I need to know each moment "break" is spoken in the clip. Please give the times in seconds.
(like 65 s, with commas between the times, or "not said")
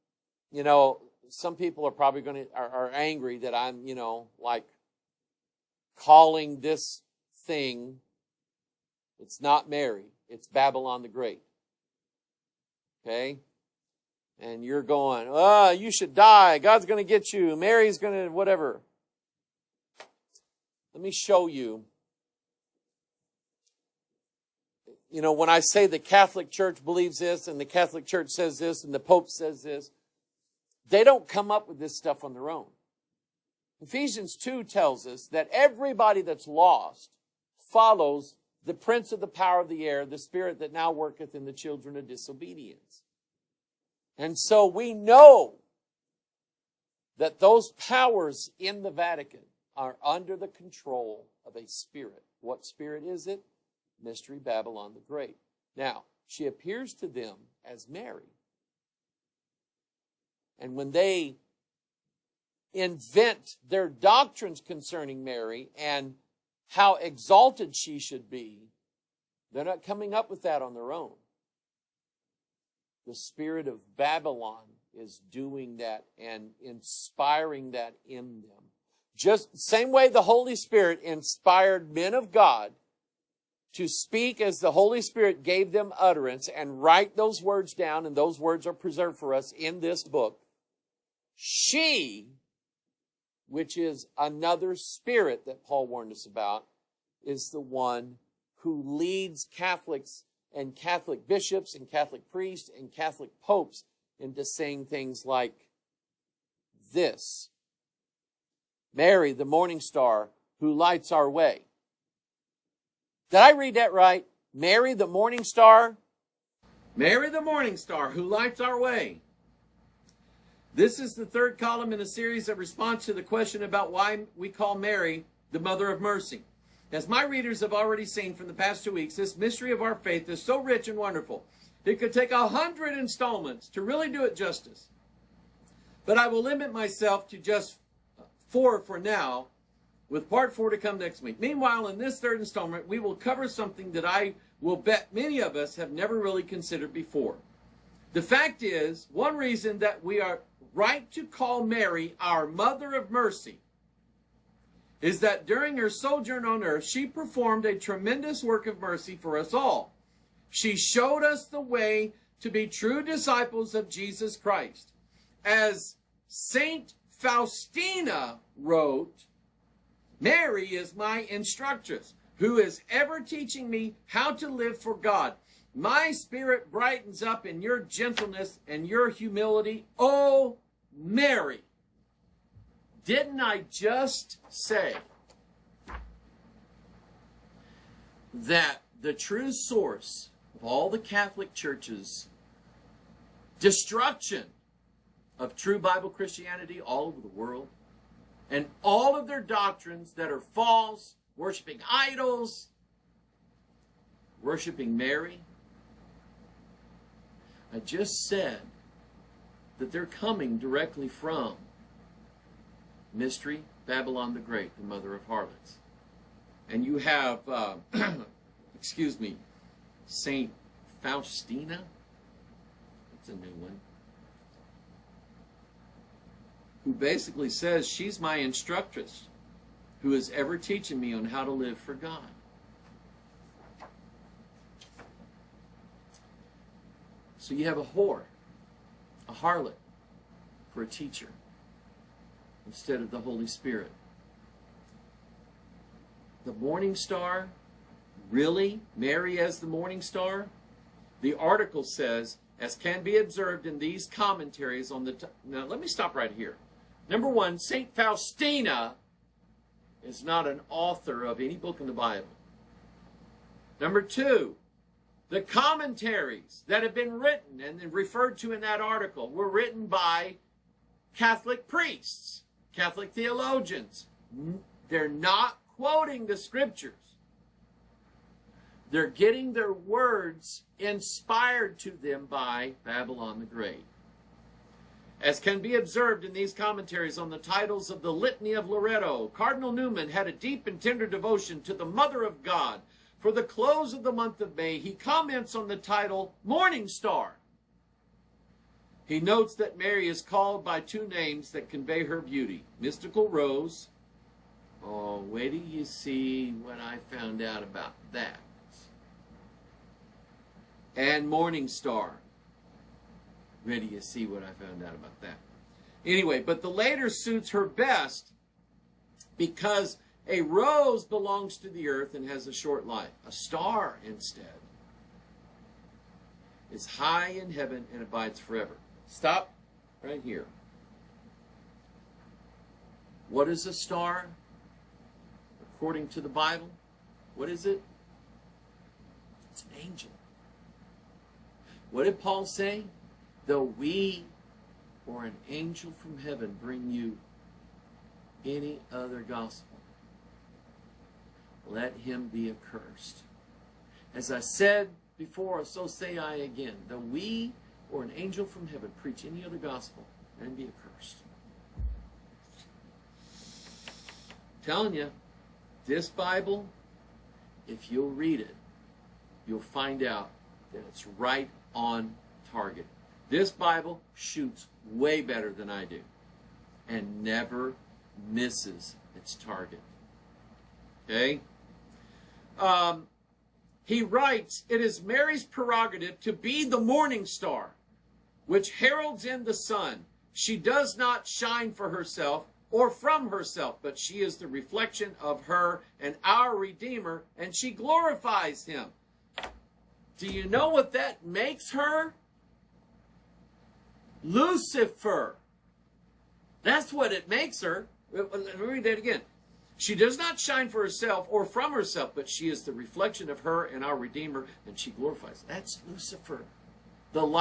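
not said.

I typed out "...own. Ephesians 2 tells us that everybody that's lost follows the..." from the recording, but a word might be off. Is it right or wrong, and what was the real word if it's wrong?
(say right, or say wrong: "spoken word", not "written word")
right.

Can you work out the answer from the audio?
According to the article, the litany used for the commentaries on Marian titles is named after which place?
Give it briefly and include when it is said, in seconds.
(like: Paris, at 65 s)
Loretto, at 288 s.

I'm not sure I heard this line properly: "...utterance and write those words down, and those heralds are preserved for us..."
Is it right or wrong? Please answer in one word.
wrong.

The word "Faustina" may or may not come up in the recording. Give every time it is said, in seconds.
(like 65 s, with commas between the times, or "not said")
167 s, 221 s, 257 s.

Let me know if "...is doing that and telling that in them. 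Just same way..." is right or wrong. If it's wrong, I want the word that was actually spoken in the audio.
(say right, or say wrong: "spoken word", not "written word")
wrong: "inspiring", not "telling".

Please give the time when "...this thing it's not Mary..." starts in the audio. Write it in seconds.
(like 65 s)
6 s.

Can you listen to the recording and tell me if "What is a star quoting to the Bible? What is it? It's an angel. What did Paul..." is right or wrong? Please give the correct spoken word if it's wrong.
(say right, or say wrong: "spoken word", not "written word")
wrong: "according", not "quoting".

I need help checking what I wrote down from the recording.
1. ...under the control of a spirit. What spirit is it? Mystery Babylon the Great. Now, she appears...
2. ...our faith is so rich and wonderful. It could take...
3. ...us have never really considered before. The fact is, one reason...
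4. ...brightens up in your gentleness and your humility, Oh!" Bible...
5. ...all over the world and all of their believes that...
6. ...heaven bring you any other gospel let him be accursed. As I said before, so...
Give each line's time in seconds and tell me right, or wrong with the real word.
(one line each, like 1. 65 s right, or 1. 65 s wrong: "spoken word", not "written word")
1. 50 s right
2. 129 s right
3. 145 s right
4. 176 s wrong: "Mary", not "Bible"
5. 196 s wrong: "doctrines", not "believes"
6. 346 s right.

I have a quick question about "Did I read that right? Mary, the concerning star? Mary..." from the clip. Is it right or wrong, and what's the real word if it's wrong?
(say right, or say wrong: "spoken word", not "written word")
wrong: "morning", not "concerning".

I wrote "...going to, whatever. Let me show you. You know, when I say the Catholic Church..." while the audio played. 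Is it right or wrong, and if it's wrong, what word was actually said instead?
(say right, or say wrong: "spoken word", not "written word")
right.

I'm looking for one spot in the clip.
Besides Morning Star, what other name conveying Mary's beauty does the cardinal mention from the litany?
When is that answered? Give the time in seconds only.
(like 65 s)
302 s.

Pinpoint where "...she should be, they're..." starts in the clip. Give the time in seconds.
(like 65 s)
67 s.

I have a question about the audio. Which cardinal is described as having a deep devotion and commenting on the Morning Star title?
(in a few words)
Cardinal Newman.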